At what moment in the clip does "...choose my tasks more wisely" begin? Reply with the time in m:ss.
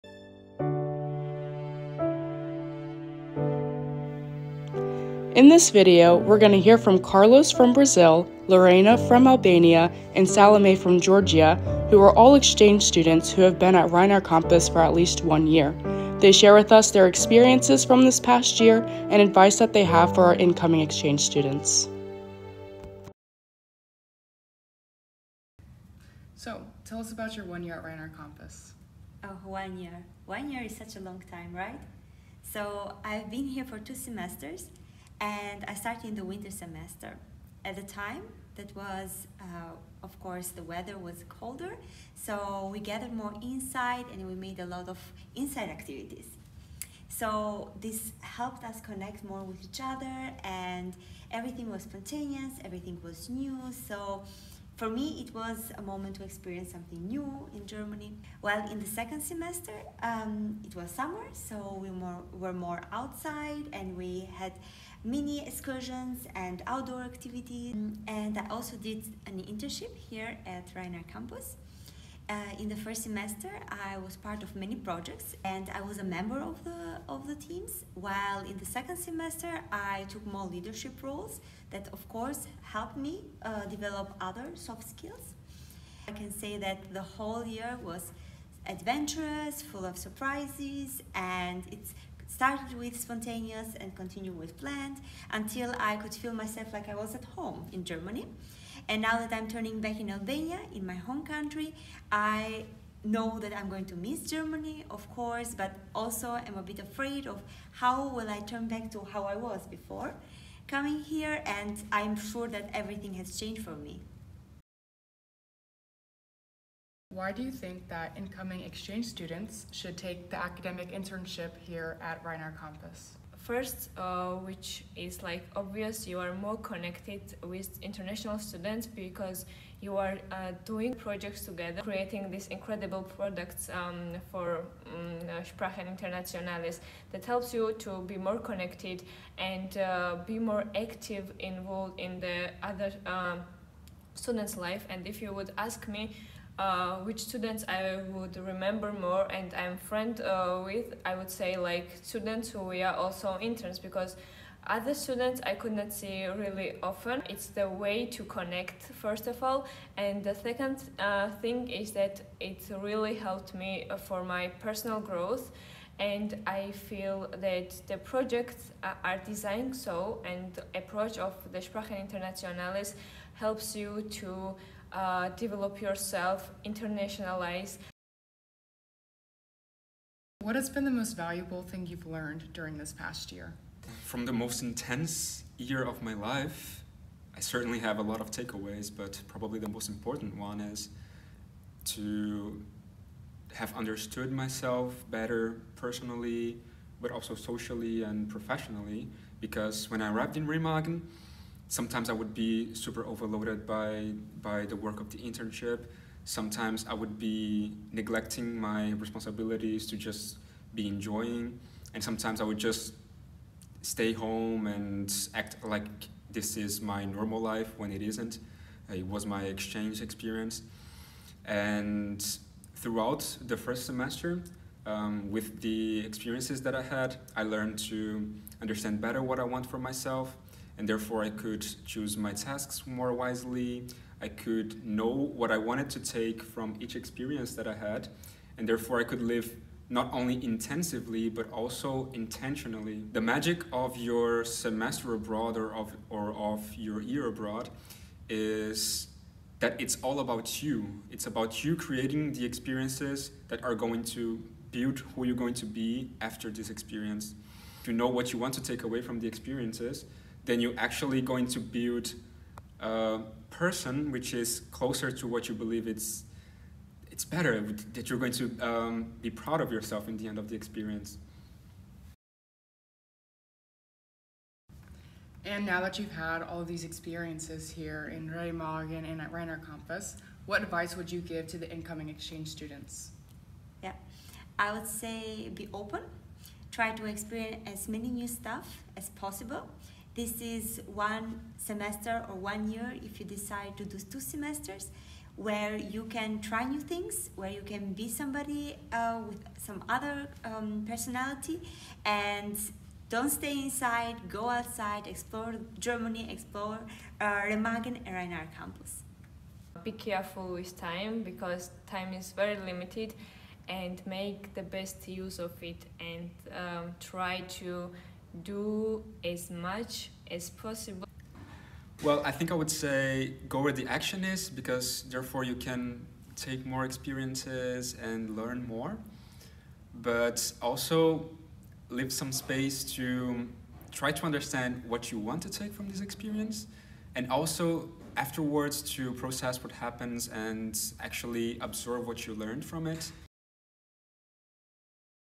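3:51.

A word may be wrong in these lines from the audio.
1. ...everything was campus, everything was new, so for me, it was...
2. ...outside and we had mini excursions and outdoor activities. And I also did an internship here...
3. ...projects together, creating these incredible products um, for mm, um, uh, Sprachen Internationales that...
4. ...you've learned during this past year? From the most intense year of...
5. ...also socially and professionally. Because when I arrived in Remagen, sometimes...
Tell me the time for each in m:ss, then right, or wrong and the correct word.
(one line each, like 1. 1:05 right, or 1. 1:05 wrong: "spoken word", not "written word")
1. 0:51 wrong: "spontaneous", not "campus"
2. 1:02 right
3. 2:10 right
4. 3:01 right
5. 3:17 right.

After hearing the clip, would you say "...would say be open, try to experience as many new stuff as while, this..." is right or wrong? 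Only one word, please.
wrong.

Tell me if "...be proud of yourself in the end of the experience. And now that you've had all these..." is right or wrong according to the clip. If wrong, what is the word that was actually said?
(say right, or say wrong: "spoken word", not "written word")
right.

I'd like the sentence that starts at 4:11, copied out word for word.
It's about you creating the experiences that are going to build who you're going to be after this experience.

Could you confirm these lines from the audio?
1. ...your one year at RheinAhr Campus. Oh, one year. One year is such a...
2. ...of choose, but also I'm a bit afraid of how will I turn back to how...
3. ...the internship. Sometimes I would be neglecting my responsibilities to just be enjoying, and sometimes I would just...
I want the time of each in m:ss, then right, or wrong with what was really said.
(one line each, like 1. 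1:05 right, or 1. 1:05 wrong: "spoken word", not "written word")
1. 0:27 right
2. 1:44 wrong: "course", not "choose"
3. 3:25 right.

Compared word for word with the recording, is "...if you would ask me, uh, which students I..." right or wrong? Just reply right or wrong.
right.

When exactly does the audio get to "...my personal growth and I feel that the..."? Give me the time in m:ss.
2:44.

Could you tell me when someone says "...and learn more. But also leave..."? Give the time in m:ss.
5:28.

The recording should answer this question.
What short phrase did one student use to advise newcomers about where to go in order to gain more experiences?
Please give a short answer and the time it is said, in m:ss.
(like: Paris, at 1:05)
Go where the action is, at 5:23.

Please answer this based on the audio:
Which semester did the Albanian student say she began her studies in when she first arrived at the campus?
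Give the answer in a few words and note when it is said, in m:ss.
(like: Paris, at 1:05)
Winter semester, at 0:36.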